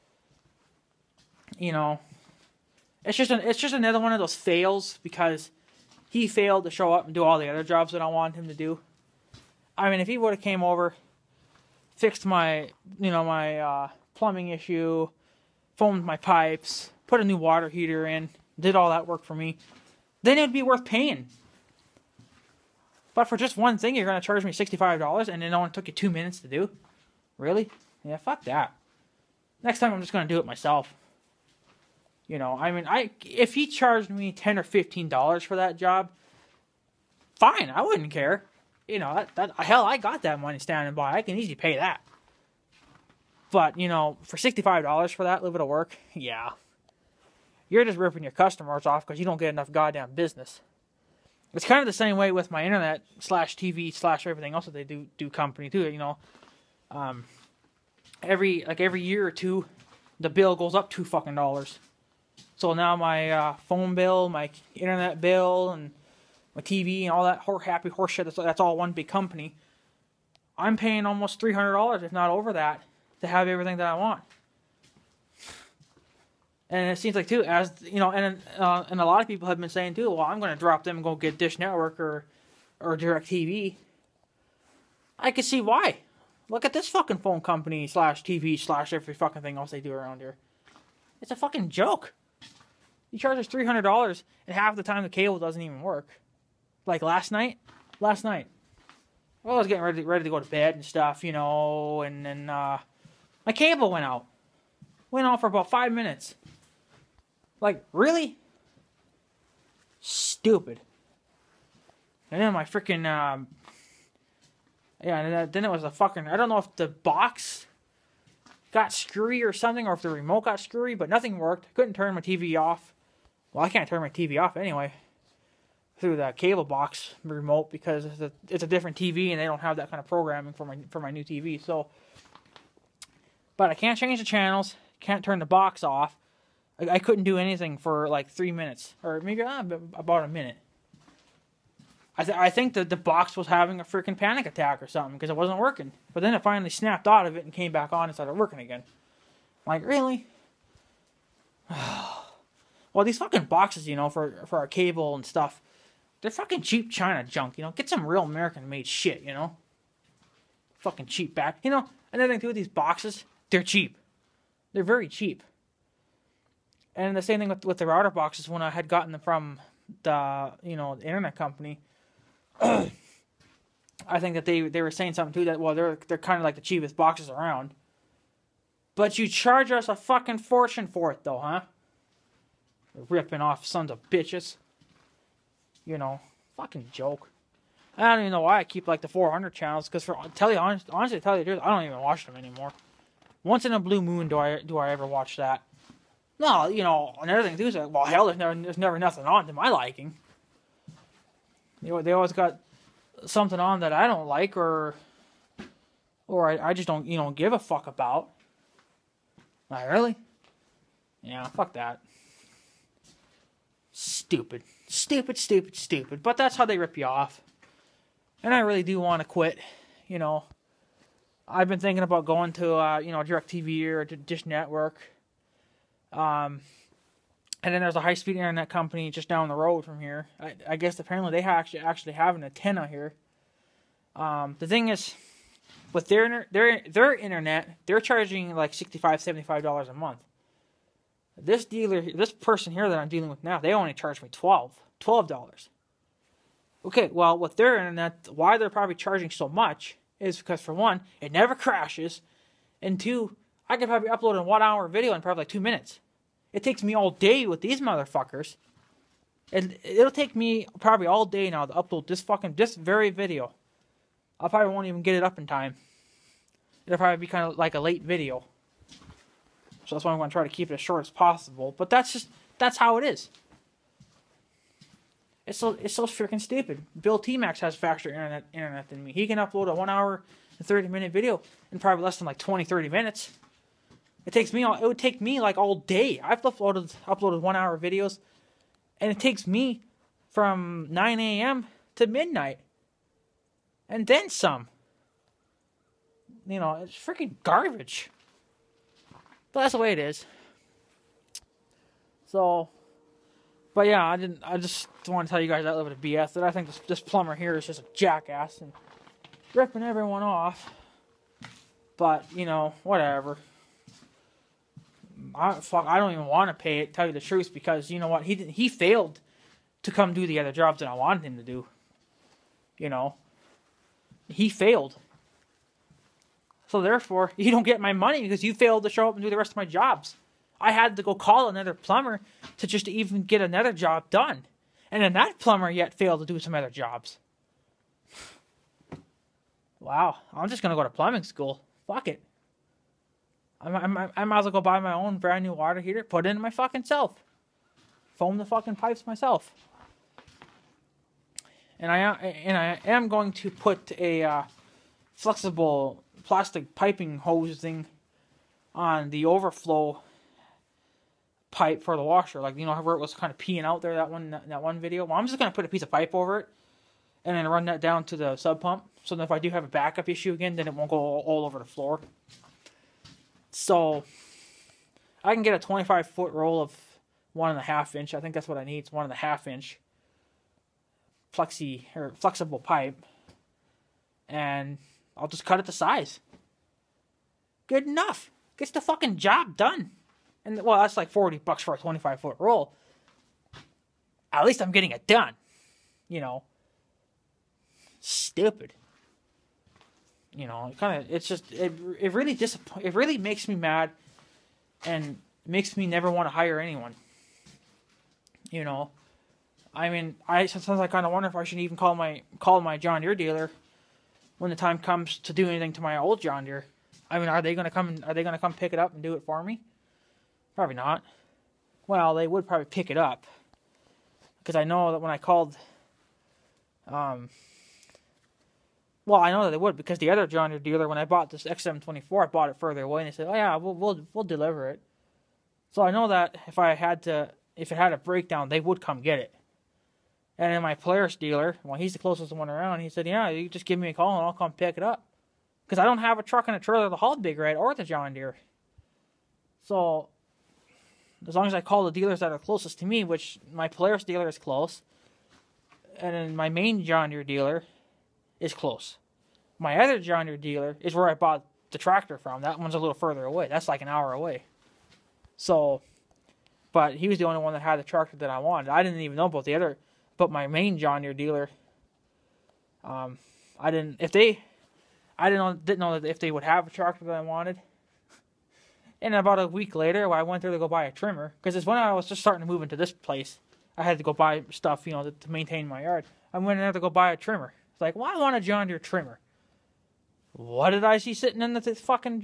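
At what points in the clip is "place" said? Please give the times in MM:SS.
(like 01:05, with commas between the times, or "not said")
08:02.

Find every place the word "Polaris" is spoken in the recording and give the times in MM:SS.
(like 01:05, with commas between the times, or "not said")
07:20, 07:33.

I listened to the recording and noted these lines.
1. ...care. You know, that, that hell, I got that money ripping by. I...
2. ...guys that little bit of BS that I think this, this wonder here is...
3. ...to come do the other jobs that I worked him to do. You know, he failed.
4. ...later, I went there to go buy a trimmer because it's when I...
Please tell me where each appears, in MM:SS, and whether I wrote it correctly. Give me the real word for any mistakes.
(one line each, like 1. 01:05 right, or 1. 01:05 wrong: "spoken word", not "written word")
1. 00:38 wrong: "standing", not "ripping"
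2. 05:05 wrong: "plumber", not "wonder"
3. 05:19 wrong: "wanted", not "worked"
4. 07:59 right.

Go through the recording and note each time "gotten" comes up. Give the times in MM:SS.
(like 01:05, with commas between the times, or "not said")
02:48.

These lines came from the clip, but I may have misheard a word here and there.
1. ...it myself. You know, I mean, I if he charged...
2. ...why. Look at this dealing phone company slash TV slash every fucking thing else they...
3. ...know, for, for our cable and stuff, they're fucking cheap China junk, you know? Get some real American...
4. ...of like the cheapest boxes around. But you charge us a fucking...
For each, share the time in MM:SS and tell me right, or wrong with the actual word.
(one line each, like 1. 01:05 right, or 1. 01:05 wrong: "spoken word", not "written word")
1. 00:30 right
2. 01:25 wrong: "fucking", not "dealing"
3. 02:33 right
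4. 02:56 right.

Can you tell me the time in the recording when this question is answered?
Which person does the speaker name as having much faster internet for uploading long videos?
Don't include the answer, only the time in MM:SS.
04:36.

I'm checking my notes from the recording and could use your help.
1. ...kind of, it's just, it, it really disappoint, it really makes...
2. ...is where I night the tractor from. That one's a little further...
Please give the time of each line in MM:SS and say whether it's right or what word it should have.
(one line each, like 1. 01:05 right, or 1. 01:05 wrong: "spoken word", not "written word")
1. 06:40 right
2. 07:40 wrong: "bought", not "night".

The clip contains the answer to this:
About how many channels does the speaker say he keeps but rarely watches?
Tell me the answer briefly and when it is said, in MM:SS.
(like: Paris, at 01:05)
400, at 03:09.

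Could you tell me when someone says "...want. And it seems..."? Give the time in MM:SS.
01:13.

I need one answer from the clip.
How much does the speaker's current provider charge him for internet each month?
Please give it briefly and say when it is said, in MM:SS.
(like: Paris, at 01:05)
12 dollars, at 04:04.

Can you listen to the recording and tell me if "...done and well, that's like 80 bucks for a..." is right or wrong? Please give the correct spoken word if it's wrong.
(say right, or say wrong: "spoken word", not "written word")
wrong: "40", not "80".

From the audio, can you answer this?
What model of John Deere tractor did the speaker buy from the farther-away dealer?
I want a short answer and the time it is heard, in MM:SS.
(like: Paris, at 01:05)
XM24, at 07:11.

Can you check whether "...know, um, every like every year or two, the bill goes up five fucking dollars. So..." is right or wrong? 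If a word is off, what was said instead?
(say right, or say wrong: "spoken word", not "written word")
wrong: "two", not "five".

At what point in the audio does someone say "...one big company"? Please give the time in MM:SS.
01:08.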